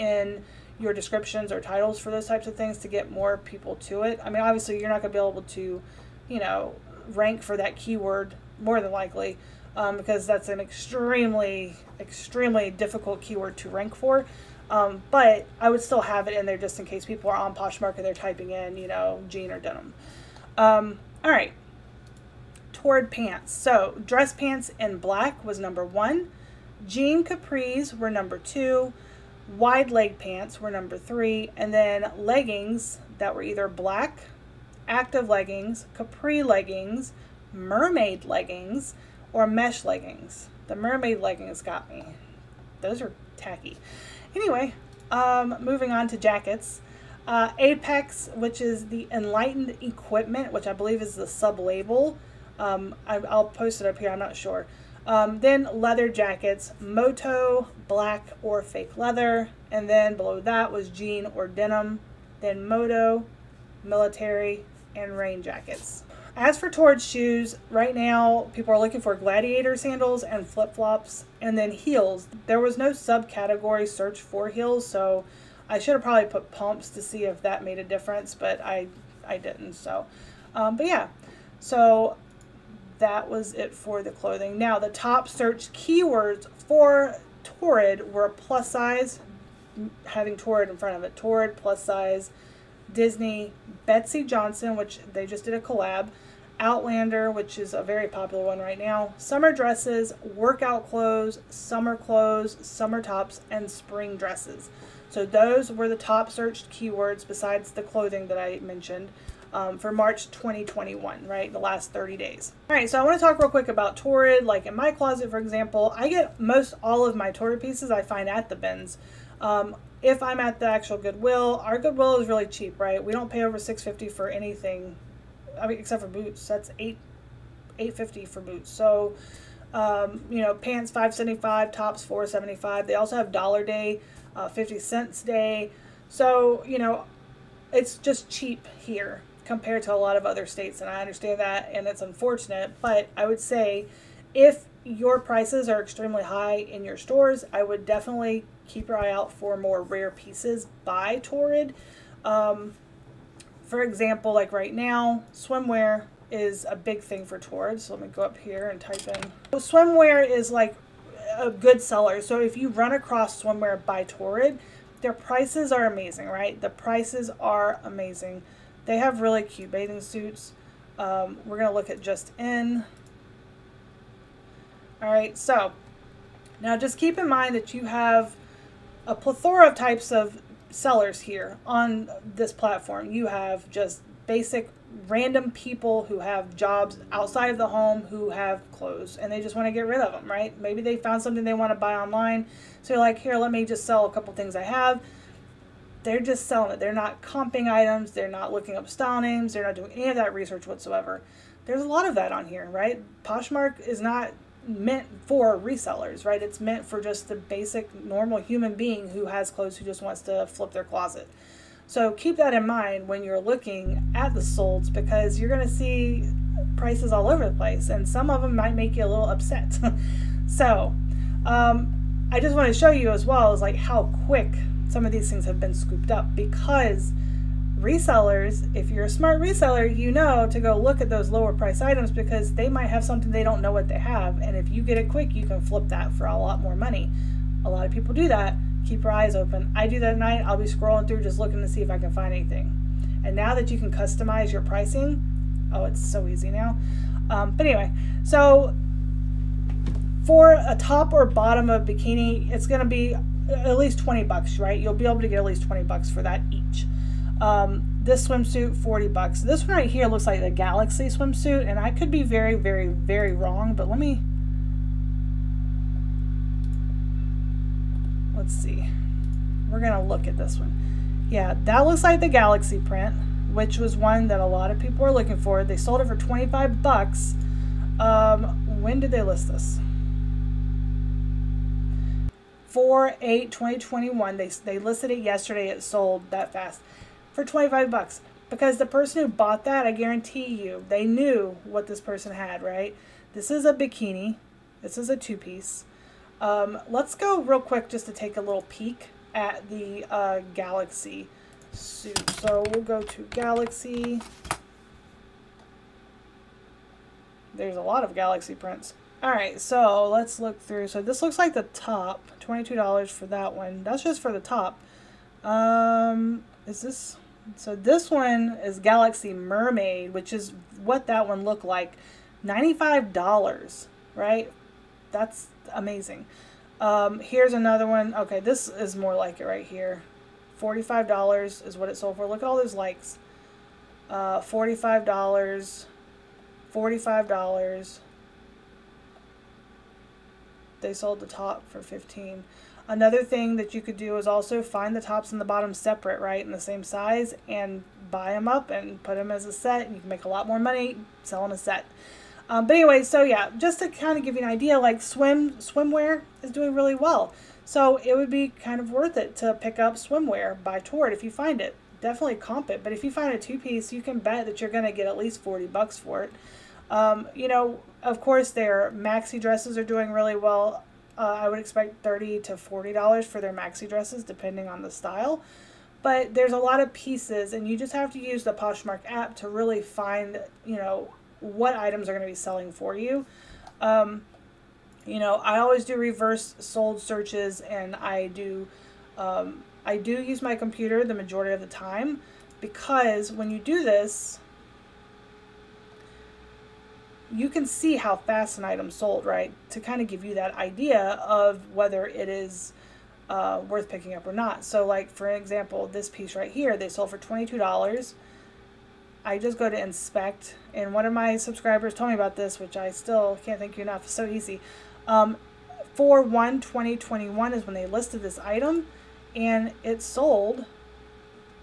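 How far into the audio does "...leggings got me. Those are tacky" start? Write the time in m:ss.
0:41.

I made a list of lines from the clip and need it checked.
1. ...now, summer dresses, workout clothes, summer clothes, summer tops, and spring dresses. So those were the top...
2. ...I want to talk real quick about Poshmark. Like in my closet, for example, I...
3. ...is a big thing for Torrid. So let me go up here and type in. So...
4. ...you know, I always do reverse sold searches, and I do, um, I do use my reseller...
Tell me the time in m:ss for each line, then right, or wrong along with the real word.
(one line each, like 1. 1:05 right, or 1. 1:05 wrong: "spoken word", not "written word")
1. 1:38 right
2. 1:52 wrong: "Torrid", not "Poshmark"
3. 2:36 right
4. 6:25 wrong: "computer", not "reseller".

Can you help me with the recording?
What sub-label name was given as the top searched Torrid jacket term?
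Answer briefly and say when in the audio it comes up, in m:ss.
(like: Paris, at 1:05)
Apex, at 0:47.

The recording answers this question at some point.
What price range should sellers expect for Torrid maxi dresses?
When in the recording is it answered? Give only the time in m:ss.
6:12.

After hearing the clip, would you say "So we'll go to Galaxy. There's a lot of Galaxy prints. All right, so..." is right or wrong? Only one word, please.
right.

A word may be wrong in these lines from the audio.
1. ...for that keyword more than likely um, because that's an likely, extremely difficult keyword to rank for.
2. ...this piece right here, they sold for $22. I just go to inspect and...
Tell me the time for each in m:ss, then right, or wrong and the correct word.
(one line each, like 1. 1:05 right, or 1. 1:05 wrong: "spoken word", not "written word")
1. 0:07 wrong: "extremely", not "likely"
2. 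6:45 right.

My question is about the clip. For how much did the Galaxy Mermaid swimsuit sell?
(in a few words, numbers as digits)
$95.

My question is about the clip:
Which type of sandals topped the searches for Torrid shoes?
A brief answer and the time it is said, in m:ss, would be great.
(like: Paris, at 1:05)
Gladiator sandals, at 1:09.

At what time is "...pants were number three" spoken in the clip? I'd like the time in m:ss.
0:30.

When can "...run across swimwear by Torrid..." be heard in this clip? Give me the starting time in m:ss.
2:42.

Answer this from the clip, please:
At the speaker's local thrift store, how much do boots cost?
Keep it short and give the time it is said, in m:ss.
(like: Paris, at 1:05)
$8.50, at 2:07.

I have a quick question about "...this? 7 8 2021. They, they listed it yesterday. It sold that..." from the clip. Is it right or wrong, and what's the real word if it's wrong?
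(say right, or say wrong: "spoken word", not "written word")
wrong: "4", not "7".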